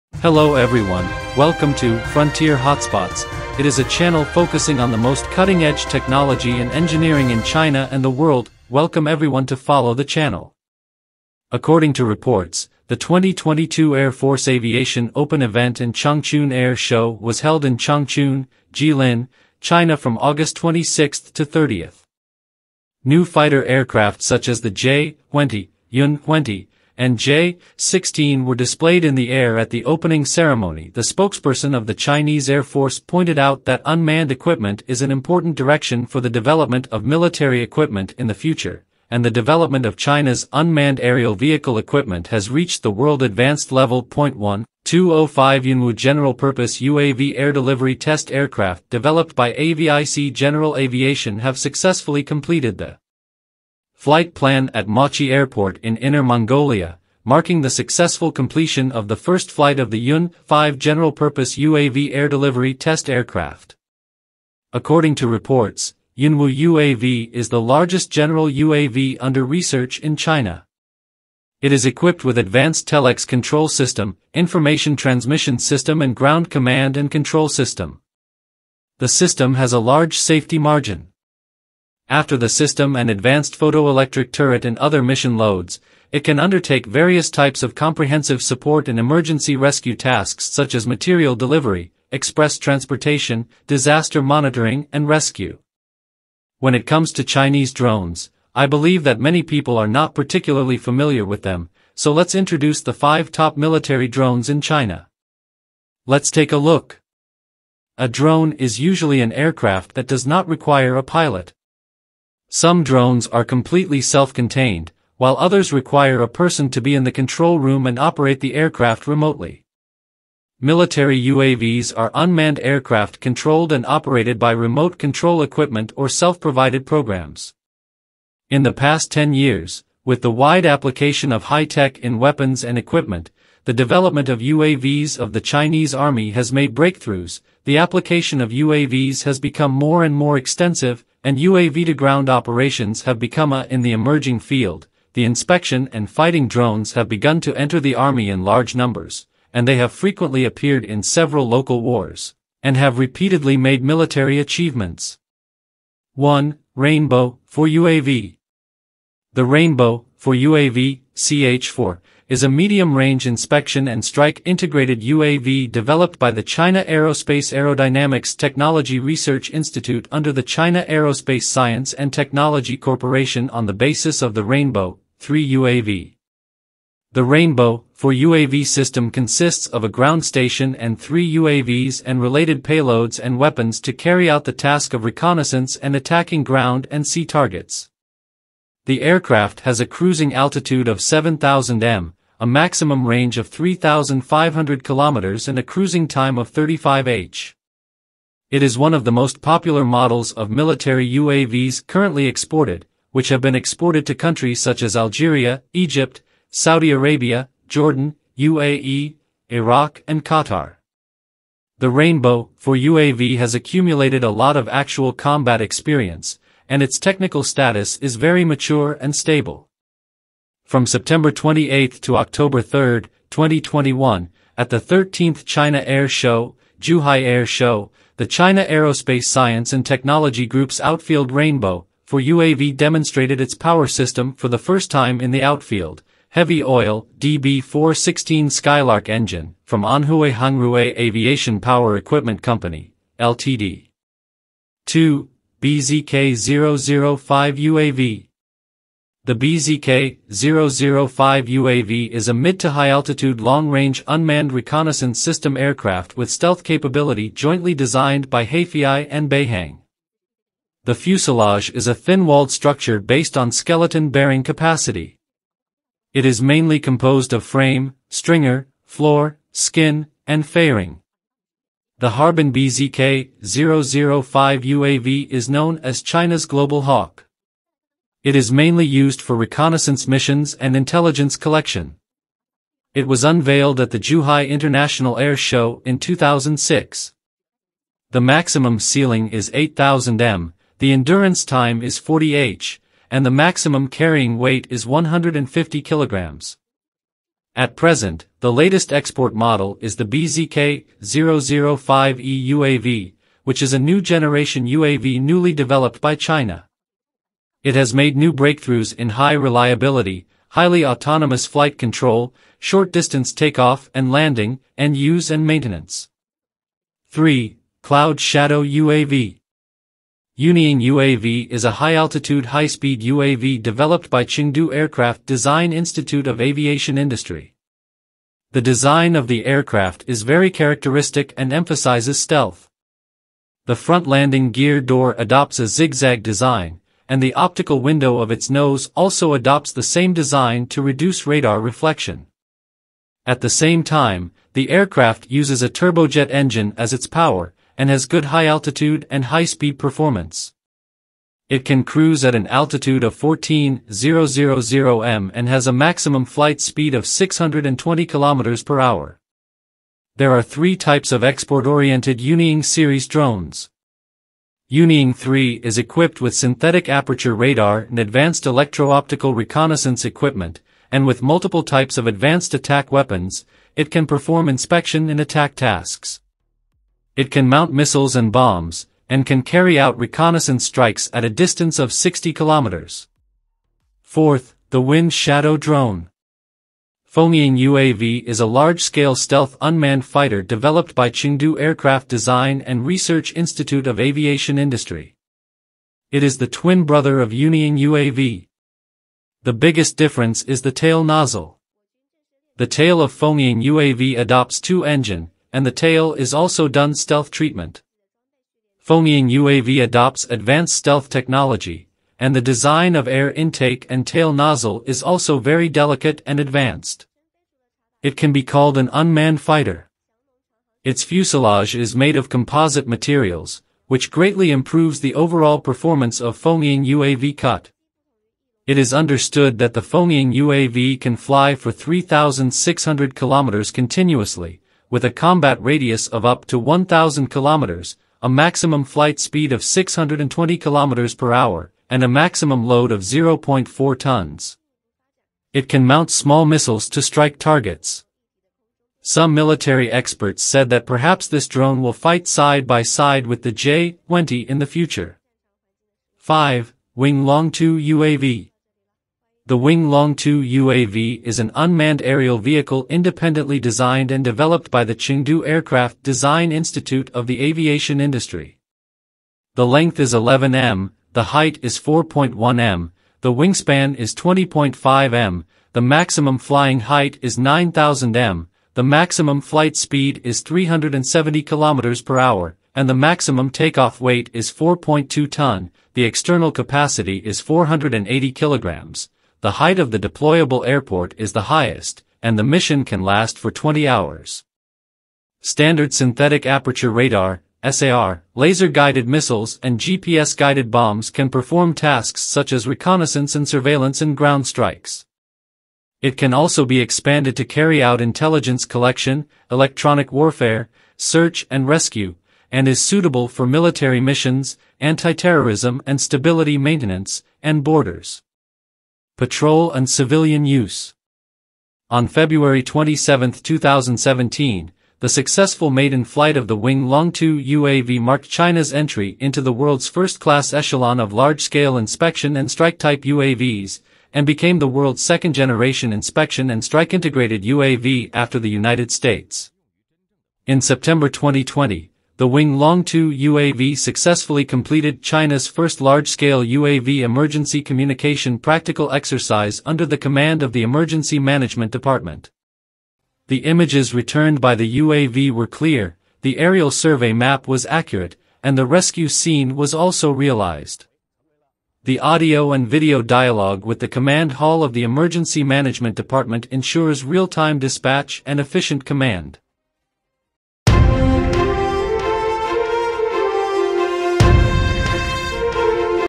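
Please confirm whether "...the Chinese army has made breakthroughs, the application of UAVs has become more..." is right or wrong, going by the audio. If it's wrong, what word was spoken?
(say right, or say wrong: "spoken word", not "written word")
right.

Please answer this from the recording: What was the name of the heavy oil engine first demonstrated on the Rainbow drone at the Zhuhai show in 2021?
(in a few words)
DB416 Skylark.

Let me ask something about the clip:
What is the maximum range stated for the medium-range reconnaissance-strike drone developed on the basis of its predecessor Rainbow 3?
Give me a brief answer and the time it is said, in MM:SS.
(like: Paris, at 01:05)
3,500 kilometers, at 03:13.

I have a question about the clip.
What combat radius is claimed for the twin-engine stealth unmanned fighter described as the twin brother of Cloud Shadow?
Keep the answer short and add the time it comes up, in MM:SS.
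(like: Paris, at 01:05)
1,000 kilometers, at 07:16.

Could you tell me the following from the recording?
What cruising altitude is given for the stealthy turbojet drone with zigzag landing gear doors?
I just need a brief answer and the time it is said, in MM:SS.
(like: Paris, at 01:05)
14,000 m, at 05:53.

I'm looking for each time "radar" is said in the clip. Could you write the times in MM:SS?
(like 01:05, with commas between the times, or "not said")
05:41, 06:07, 08:16.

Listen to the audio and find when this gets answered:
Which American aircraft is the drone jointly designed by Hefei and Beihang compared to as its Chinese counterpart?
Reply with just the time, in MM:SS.
04:36.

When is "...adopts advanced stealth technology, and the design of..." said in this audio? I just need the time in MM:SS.
06:49.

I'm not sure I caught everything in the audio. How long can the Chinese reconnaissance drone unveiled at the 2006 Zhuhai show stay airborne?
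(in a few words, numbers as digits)
40 hours.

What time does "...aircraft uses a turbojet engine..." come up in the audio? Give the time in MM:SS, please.
05:44.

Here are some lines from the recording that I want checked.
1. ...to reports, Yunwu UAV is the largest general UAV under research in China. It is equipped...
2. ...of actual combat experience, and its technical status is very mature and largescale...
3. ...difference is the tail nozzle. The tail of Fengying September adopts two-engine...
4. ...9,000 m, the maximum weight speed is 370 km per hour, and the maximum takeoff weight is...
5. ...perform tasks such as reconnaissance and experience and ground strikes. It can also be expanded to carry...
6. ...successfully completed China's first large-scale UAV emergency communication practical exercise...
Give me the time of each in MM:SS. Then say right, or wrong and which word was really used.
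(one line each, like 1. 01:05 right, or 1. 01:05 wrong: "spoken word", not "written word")
1. 01:05 right
2. 03:34 wrong: "stable", not "largescale"
3. 06:39 wrong: "UAV", not "September"
4. 07:57 wrong: "flight", not "weight"
5. 08:21 wrong: "surveillance", not "experience"
6. 09:03 right.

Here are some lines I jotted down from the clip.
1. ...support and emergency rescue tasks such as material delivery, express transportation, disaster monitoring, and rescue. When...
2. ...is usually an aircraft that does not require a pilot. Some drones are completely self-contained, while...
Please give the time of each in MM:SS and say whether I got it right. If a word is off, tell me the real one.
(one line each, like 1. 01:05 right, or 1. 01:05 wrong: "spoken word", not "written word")
1. 01:28 right
2. 01:48 right.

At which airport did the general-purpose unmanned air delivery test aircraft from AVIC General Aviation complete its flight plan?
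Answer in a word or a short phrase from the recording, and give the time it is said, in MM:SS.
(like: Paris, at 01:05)
Machi Airport, at 00:54.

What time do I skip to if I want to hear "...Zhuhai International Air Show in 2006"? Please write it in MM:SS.
04:43.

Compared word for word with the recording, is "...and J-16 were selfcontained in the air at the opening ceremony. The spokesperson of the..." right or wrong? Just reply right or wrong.
wrong.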